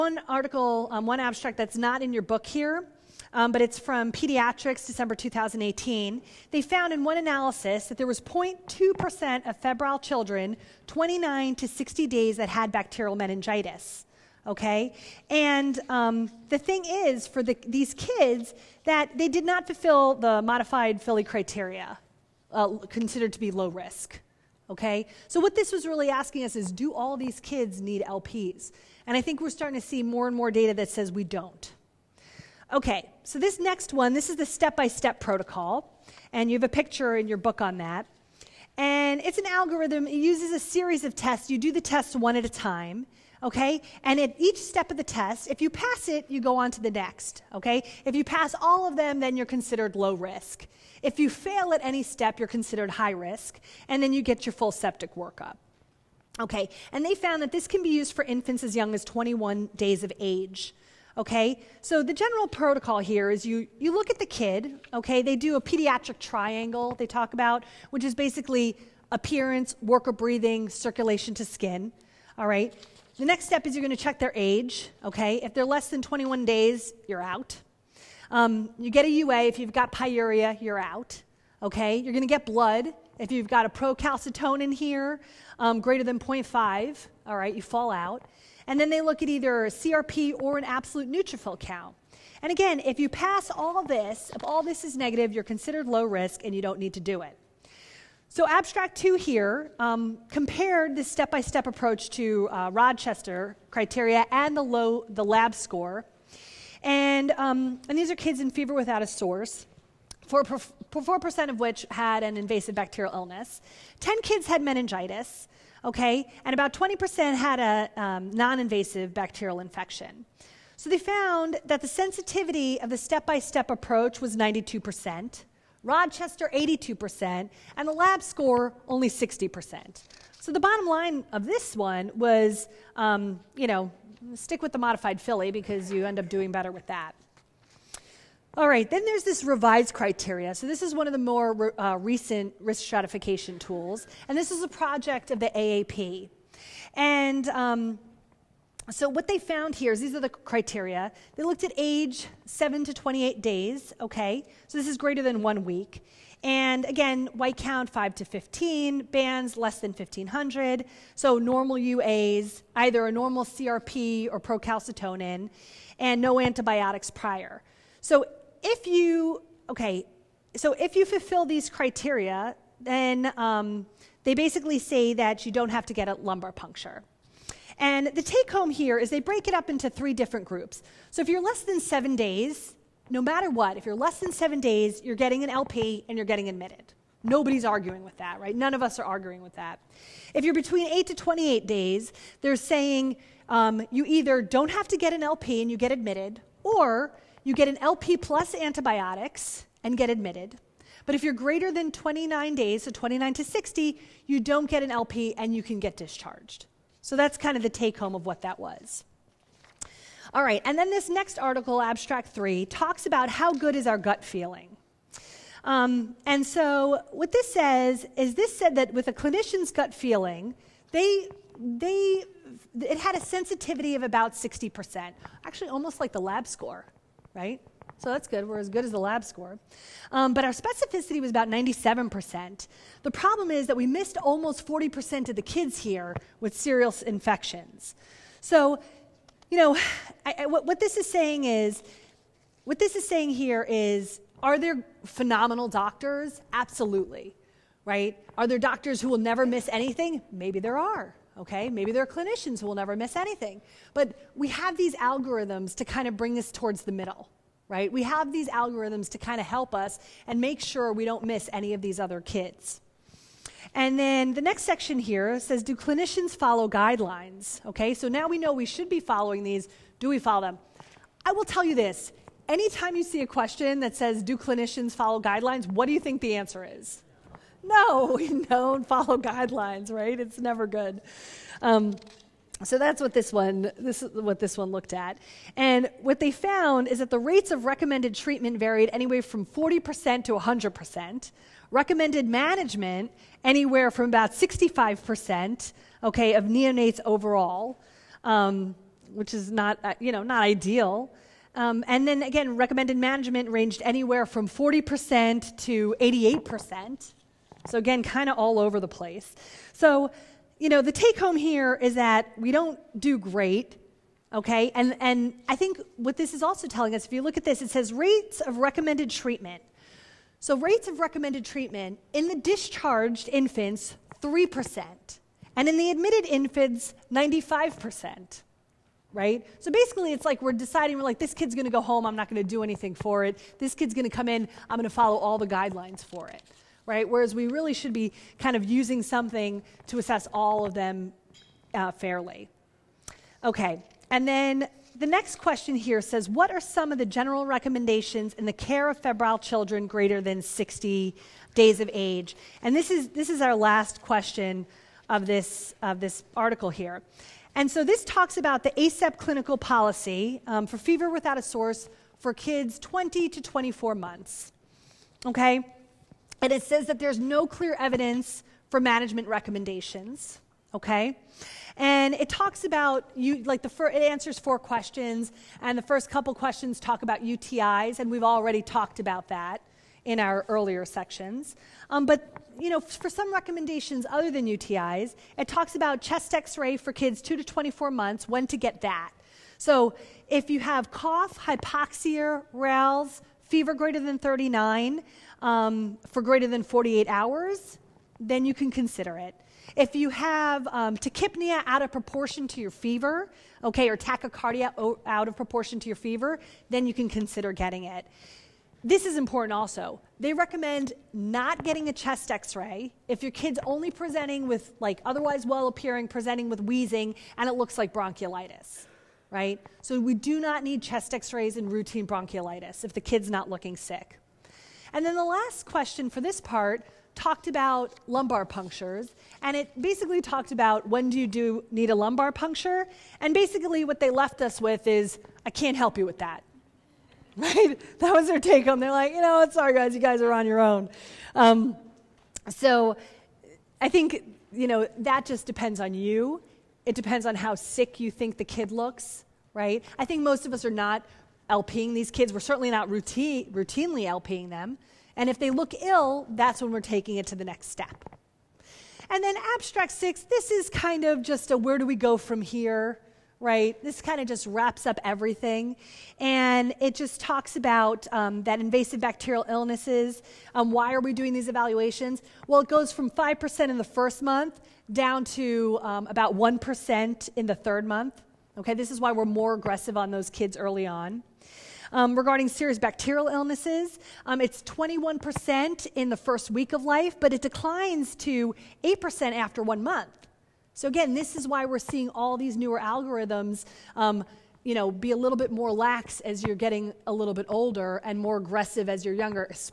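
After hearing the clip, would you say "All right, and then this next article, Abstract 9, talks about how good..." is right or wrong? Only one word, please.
wrong.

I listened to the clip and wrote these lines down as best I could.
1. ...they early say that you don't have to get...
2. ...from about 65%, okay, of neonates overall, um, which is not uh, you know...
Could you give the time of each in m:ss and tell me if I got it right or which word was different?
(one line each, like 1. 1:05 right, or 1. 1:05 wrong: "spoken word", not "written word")
1. 2:54 wrong: "basically", not "early"
2. 4:53 right.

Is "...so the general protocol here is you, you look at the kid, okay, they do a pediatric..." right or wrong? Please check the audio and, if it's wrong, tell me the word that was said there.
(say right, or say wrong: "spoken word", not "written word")
right.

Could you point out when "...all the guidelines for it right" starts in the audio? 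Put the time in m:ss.
5:35.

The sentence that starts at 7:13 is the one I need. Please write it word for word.
And basically, what they left us with is, I can't help you with that.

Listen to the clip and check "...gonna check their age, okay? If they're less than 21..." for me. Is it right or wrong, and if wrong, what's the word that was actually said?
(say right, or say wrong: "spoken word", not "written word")
right.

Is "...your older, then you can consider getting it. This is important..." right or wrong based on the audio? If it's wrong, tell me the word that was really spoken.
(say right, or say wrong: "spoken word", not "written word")
wrong: "fever", not "older".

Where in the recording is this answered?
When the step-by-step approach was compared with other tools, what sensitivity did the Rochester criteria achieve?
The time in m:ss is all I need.
2:05.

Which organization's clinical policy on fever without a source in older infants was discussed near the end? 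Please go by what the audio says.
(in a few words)
ACEP.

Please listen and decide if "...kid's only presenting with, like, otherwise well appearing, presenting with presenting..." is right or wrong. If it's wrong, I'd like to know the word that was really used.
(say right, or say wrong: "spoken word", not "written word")
wrong: "wheezing", not "presenting".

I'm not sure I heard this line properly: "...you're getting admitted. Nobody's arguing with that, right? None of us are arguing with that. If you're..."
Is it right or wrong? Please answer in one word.
right.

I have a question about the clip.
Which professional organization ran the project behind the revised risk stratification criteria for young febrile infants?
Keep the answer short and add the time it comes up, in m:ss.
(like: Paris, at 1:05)
AAP, at 2:25.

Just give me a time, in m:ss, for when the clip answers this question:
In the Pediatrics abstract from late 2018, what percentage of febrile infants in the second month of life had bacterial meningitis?
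0:08.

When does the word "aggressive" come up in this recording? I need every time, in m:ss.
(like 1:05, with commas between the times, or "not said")
7:59, 8:18.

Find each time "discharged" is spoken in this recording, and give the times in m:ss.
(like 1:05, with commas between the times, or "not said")
3:25, 5:22.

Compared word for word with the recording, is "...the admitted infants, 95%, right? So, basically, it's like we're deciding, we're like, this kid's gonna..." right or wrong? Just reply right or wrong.
right.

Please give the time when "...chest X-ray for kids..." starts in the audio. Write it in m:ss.
6:26.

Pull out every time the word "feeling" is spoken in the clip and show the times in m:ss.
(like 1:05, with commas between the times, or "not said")
3:34, 3:39.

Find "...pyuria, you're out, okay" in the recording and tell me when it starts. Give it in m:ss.
1:19.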